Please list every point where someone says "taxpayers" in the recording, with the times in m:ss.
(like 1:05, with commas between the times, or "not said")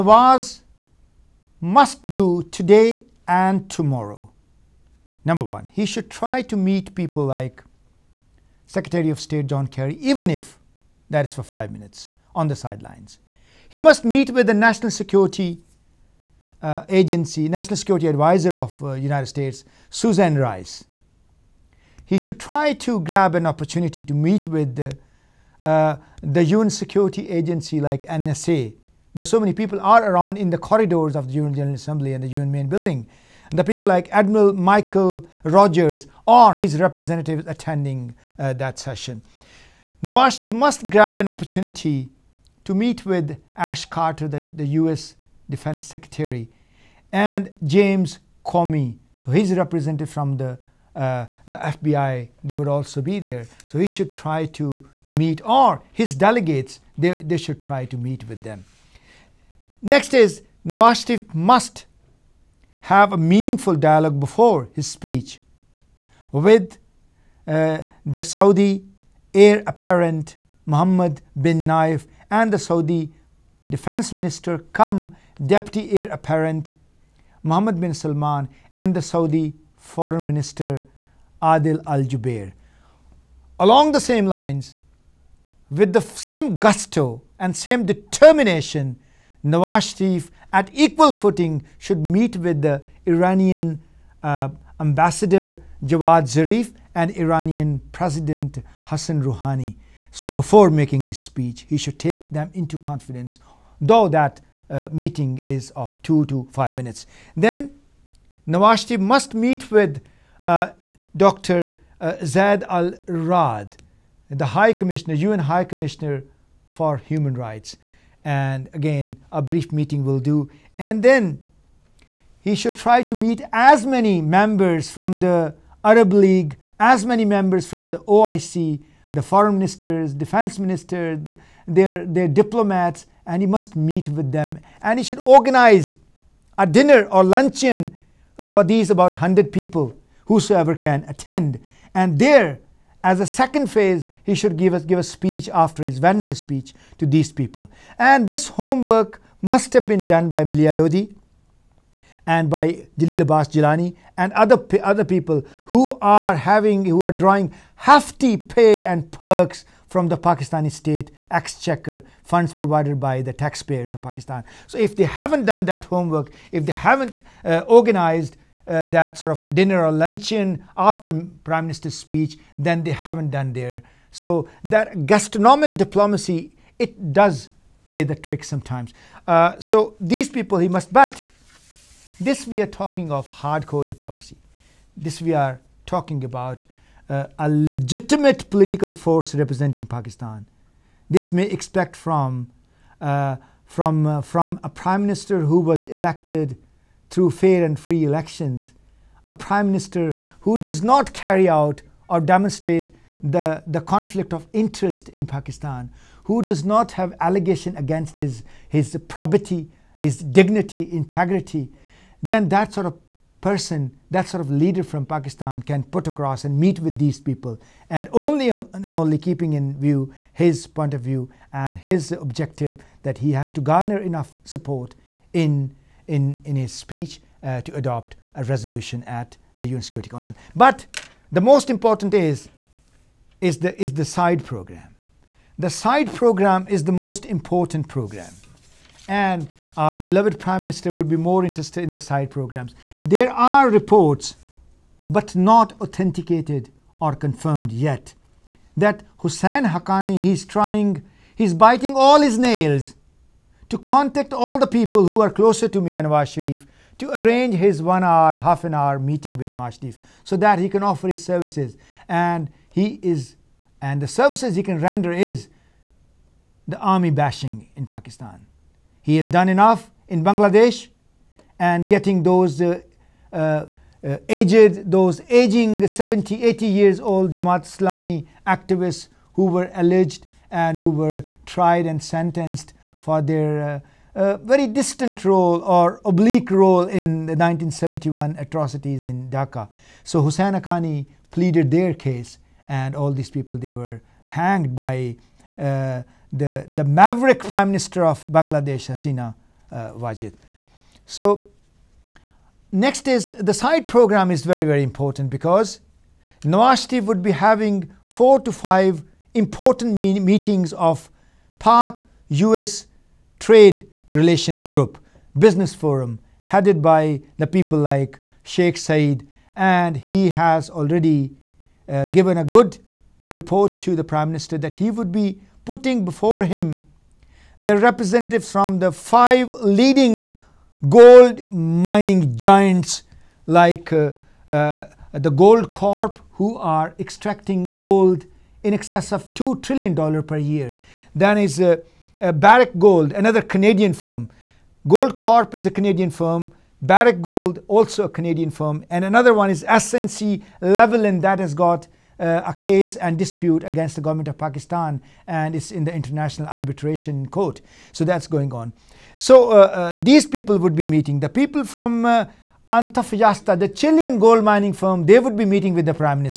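2:43.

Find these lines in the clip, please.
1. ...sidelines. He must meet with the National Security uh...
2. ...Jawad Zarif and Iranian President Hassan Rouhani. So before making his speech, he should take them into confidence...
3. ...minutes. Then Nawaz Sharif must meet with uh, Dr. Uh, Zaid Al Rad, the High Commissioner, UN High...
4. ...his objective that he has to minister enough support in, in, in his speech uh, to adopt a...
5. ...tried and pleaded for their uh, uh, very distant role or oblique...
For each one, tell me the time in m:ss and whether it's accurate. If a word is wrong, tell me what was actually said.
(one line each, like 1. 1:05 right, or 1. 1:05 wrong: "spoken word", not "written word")
1. 0:12 right
2. 1:35 right
3. 1:46 right
4. 3:41 wrong: "garner", not "minister"
5. 4:41 wrong: "sentenced", not "pleaded".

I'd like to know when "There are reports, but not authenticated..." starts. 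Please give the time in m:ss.
4:03.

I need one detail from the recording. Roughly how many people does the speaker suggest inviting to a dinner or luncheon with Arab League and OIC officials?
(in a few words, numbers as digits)
100.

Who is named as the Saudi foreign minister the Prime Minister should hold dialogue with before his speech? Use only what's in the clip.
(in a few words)
Adel Al Jubeir.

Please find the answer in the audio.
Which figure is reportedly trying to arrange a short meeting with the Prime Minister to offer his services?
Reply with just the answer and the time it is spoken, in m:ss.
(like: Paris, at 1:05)
Hussein Haqqani, at 4:09.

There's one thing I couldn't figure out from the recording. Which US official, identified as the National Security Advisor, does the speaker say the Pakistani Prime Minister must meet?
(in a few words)
Susan Rice.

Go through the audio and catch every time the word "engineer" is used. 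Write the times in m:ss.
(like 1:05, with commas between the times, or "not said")
not said.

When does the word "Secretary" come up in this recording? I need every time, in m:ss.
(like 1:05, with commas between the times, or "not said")
0:08, 0:45.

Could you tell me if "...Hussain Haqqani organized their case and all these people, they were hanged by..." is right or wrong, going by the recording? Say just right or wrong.
wrong.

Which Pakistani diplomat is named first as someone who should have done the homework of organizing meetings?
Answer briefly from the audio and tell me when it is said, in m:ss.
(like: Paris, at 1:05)
Maleeha Lodhi, at 2:30.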